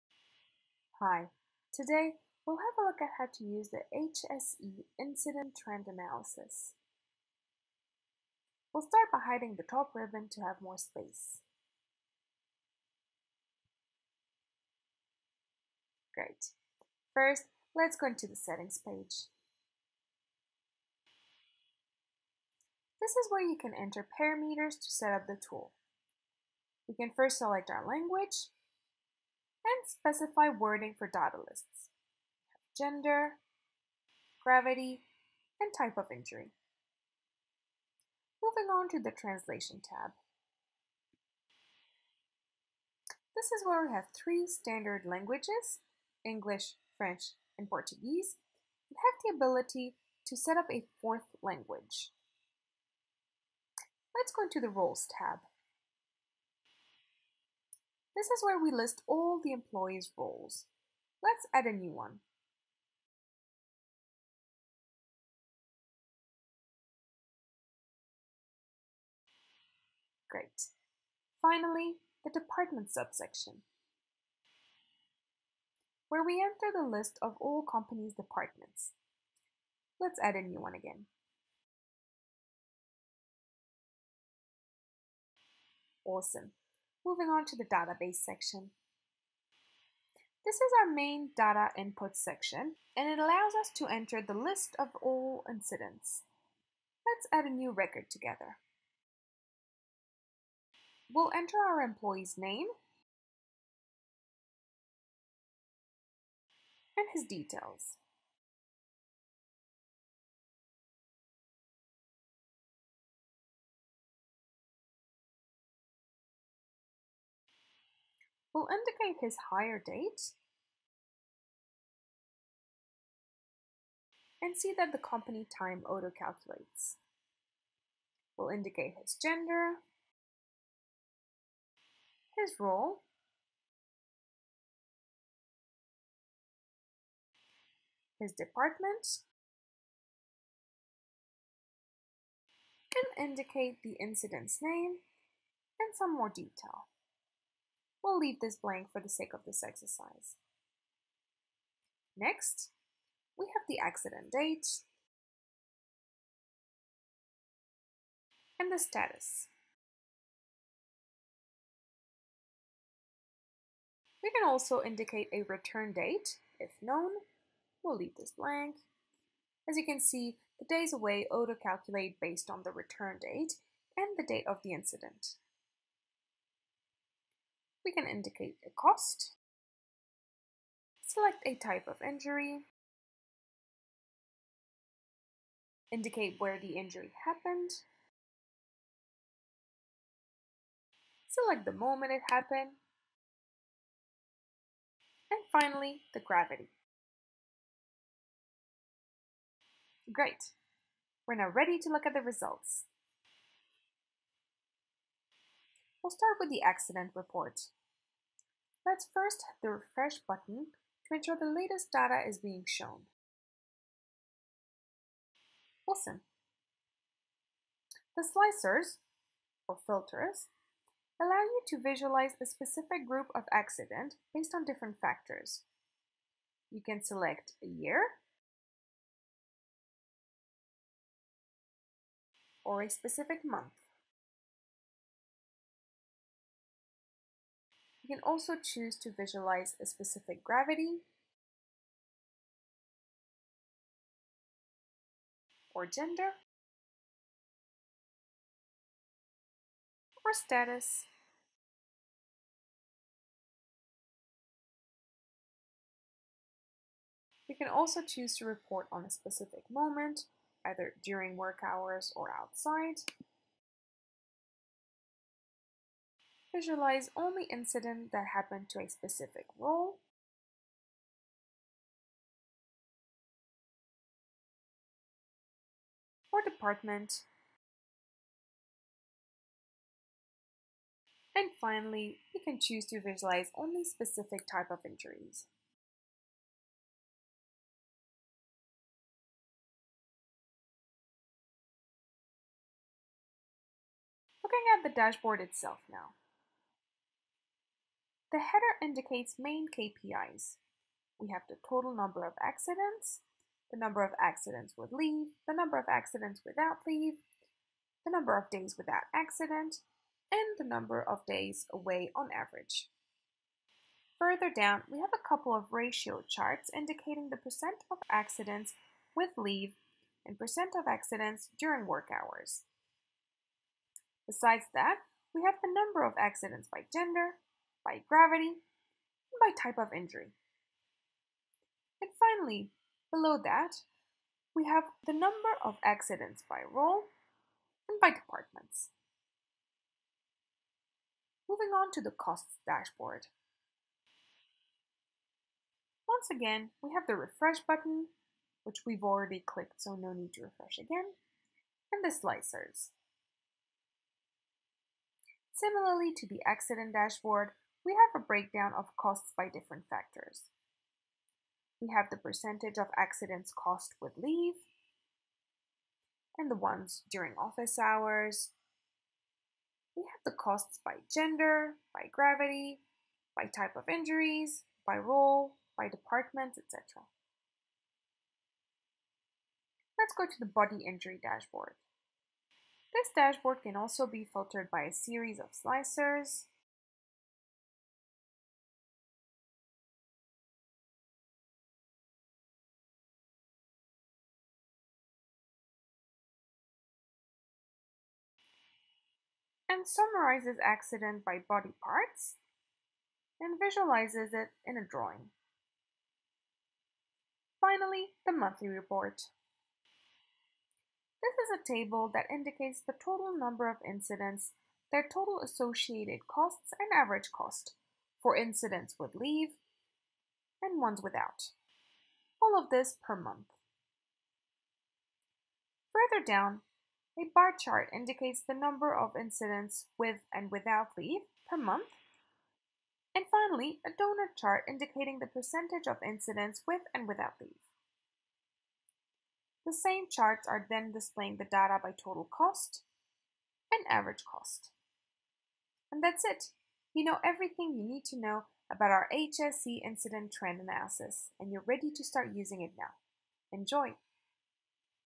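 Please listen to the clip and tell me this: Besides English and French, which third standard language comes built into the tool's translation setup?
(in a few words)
Portuguese.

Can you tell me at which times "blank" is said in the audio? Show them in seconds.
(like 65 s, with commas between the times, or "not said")
148 s, 168 s.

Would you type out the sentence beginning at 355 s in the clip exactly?
Similarly to the accident dashboard, we have a breakdown of costs by different factors.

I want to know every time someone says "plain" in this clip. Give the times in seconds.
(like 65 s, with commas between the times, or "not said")
not said.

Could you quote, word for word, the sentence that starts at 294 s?
Looking at the dashboard itself now.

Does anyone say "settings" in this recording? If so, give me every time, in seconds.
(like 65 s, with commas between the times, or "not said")
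18 s.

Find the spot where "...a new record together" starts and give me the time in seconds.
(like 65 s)
97 s.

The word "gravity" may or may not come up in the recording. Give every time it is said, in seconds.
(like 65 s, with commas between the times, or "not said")
34 s, 196 s, 240 s, 328 s, 372 s.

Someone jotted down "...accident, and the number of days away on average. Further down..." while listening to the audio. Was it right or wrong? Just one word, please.
right.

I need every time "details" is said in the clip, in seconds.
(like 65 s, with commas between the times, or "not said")
107 s, 146 s.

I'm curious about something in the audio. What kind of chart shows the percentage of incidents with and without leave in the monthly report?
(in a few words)
donut chart.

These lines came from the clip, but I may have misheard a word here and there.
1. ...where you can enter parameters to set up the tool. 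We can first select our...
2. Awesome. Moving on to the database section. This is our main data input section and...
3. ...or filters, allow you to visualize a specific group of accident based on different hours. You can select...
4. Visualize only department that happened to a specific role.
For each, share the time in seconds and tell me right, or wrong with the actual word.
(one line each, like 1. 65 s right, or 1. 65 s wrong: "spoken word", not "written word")
1. 23 s right
2. 86 s right
3. 219 s wrong: "factors", not "hours"
4. 266 s wrong: "incident", not "department".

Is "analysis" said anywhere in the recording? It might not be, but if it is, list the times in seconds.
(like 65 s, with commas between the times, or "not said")
5 s, 450 s.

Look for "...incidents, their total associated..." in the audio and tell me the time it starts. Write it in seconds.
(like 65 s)
413 s.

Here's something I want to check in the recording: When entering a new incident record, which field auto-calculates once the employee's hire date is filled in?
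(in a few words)
company time.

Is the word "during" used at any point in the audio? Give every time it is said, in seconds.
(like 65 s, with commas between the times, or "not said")
261 s, 321 s, 367 s.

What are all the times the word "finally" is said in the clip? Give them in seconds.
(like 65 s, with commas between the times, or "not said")
71 s, 195 s, 281 s, 332 s, 407 s, 433 s.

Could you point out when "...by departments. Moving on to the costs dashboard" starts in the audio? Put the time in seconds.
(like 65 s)
338 s.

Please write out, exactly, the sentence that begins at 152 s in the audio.
Next, we have the accident date and the status.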